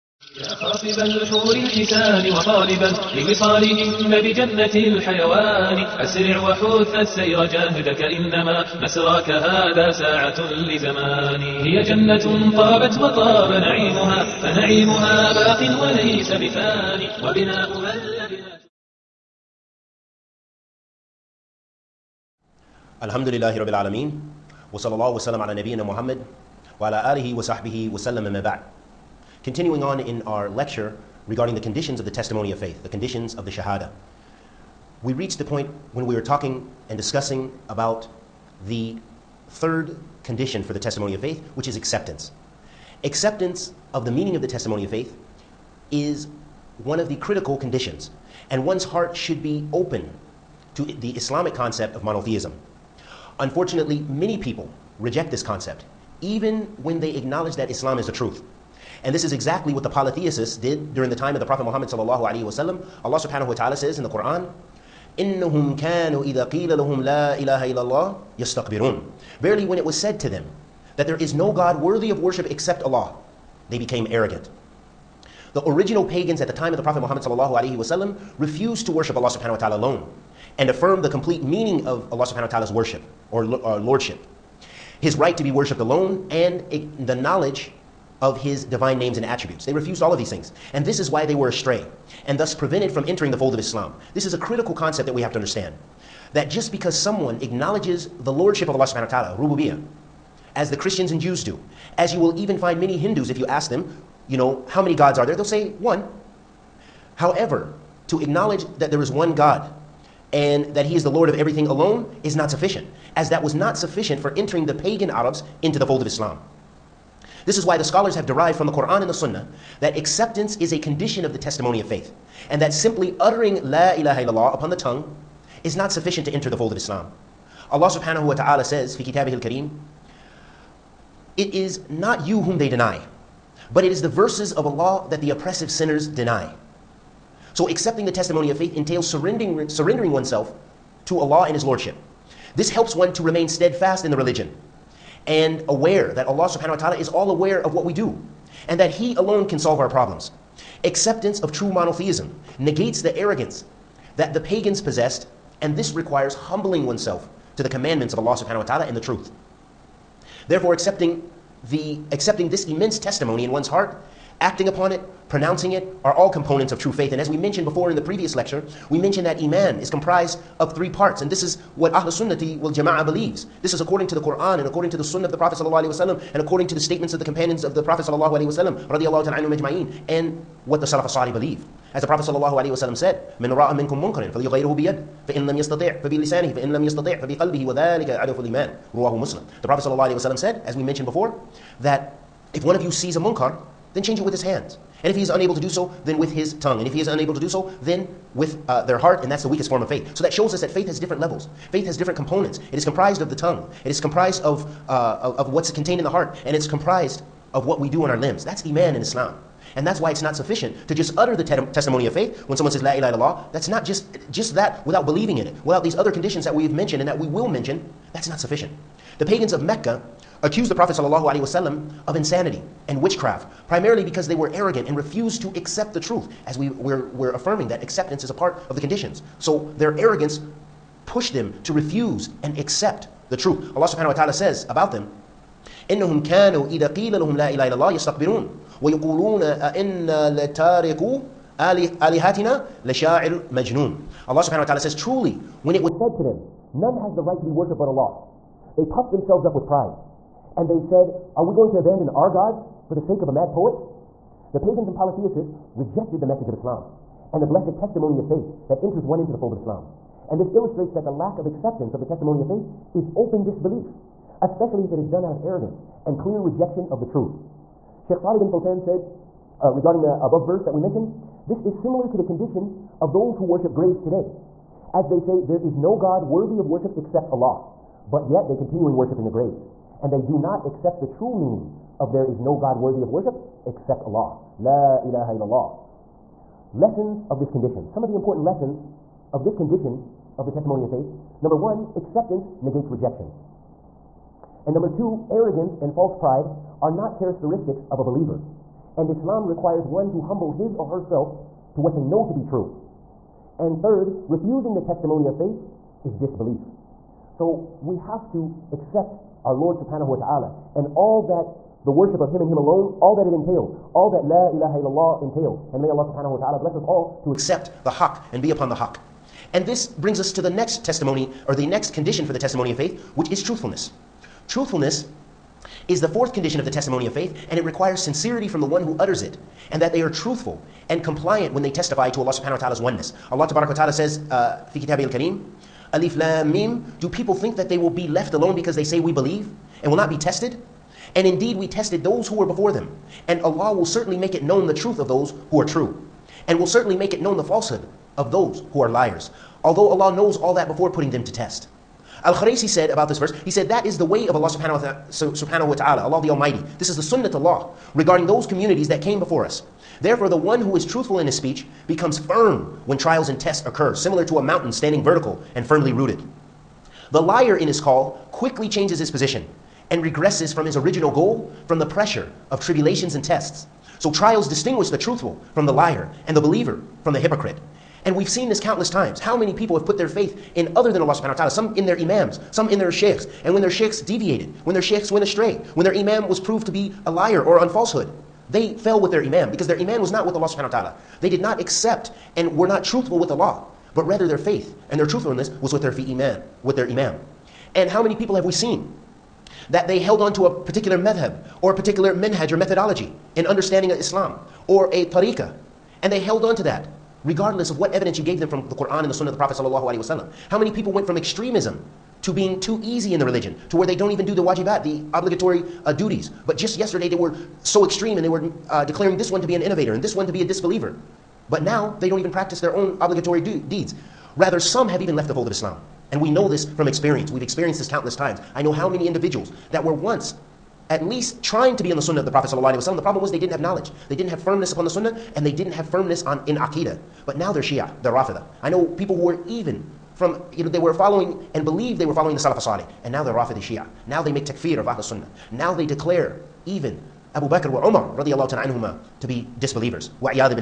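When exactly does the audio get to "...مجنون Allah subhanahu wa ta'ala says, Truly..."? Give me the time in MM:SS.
04:03.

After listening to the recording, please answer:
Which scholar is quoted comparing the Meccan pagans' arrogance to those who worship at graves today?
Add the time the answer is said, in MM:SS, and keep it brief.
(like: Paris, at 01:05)
Salih bin Fozan, at 04:28.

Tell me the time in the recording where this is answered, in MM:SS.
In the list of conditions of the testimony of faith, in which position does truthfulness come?
05:26.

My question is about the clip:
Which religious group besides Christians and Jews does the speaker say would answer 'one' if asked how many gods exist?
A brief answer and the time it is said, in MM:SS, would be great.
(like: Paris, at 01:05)
Hindus, at 01:42.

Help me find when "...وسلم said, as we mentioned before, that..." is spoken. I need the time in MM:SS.
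03:10.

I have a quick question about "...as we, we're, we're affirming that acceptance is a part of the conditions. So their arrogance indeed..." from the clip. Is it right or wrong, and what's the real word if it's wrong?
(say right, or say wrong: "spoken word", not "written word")
wrong: "pushed", not "indeed".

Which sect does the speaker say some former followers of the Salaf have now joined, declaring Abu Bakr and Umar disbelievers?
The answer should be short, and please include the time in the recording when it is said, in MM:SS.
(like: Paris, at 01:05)
Rafida Shia, at 07:23.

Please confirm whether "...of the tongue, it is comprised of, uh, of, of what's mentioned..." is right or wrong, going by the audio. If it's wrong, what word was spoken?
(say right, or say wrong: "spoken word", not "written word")
wrong: "contained", not "mentioned".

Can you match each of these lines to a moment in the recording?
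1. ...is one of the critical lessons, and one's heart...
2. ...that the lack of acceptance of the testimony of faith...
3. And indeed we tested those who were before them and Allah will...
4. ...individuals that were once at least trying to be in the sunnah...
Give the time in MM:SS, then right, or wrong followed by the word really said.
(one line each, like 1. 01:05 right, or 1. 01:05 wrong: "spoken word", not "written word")
1. 00:45 wrong: "conditions", not "lessons"
2. 04:20 right
3. 05:41 right
4. 07:09 right.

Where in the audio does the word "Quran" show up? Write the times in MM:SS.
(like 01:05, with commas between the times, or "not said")
01:04, 01:58, 02:54, 06:48.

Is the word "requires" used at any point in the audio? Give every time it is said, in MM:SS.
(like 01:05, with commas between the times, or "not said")
02:35, 04:59, 05:27.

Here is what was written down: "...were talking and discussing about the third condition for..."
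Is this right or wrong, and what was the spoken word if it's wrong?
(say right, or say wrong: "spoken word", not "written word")
right.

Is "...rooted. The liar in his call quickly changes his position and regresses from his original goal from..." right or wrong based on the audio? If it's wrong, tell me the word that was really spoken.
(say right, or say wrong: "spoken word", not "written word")
right.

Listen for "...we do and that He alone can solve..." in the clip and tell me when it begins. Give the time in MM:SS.
02:27.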